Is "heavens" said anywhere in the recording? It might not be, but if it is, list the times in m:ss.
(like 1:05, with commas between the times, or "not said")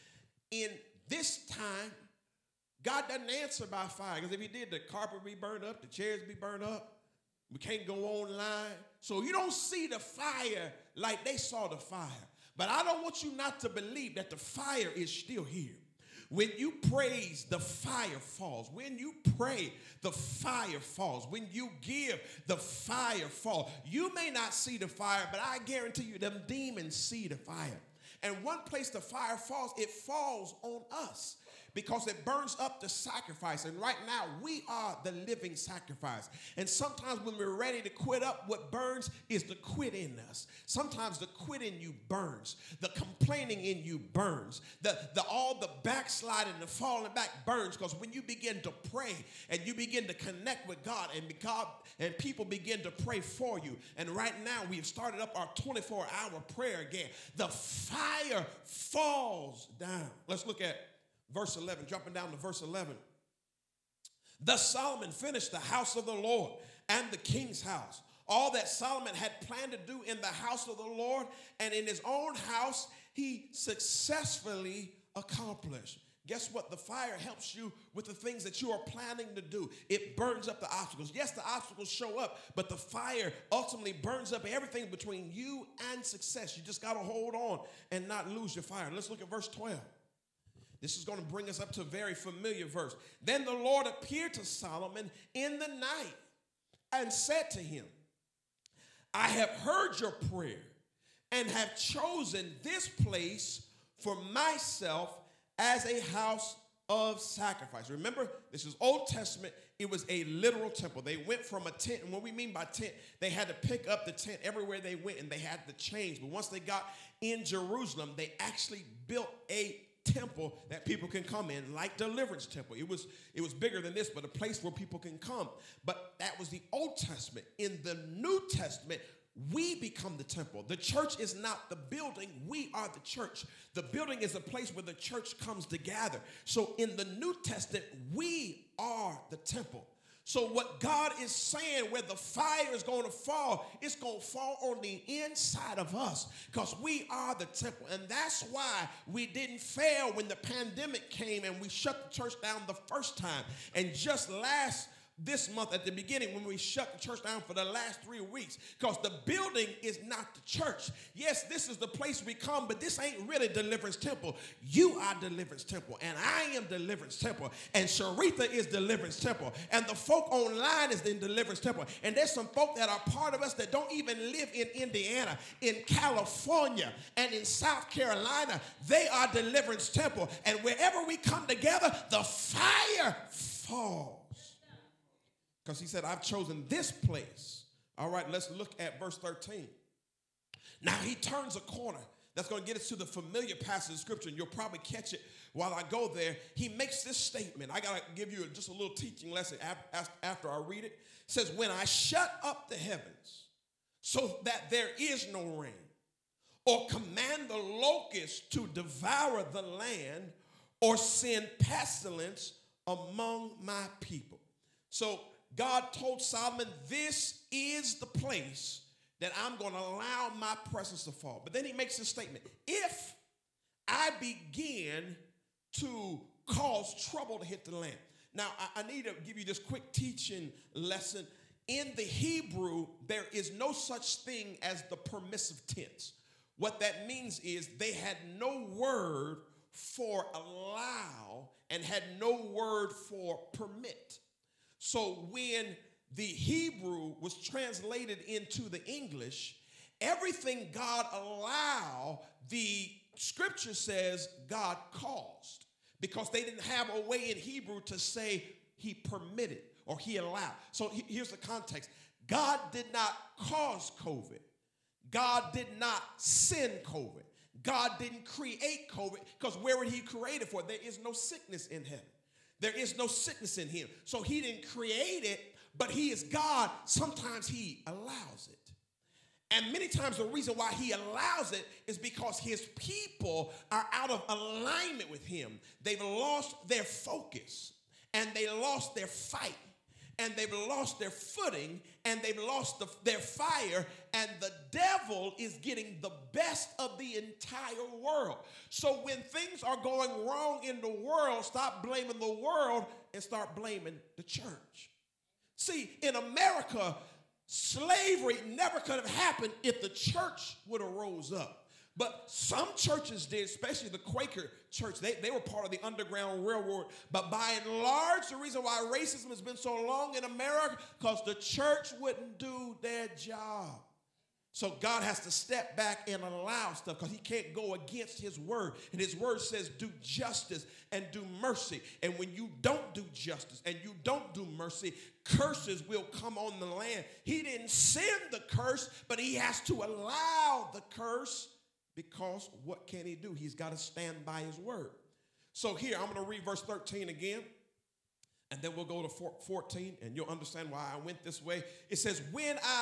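3:22, 4:31.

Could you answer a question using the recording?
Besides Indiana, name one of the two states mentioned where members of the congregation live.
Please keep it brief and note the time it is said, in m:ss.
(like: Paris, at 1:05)
California, at 2:55.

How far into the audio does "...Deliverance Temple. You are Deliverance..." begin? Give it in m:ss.
2:43.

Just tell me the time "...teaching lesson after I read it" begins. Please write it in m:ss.
3:18.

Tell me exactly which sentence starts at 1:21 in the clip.
Yes, the obstacles show up, but the fire ultimately burns up everything between you and success.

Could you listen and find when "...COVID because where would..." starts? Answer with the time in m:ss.
4:28.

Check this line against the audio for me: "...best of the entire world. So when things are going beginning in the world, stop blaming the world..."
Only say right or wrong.
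wrong.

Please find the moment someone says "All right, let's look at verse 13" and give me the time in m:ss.
3:07.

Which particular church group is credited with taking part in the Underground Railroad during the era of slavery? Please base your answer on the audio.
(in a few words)
Quaker church.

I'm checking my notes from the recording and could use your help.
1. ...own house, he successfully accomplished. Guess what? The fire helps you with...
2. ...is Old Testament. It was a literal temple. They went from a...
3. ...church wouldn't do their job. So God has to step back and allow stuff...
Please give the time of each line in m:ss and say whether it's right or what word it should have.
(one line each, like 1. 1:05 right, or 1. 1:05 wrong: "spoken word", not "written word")
1. 1:12 right
2. 1:48 right
3. 5:21 right.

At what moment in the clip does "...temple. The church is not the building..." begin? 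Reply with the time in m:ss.
2:10.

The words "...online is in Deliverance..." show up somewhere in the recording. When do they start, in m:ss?
2:50.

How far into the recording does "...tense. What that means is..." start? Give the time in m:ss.
3:55.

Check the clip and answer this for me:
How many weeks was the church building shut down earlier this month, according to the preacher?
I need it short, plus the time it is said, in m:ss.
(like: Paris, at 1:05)
three, at 2:38.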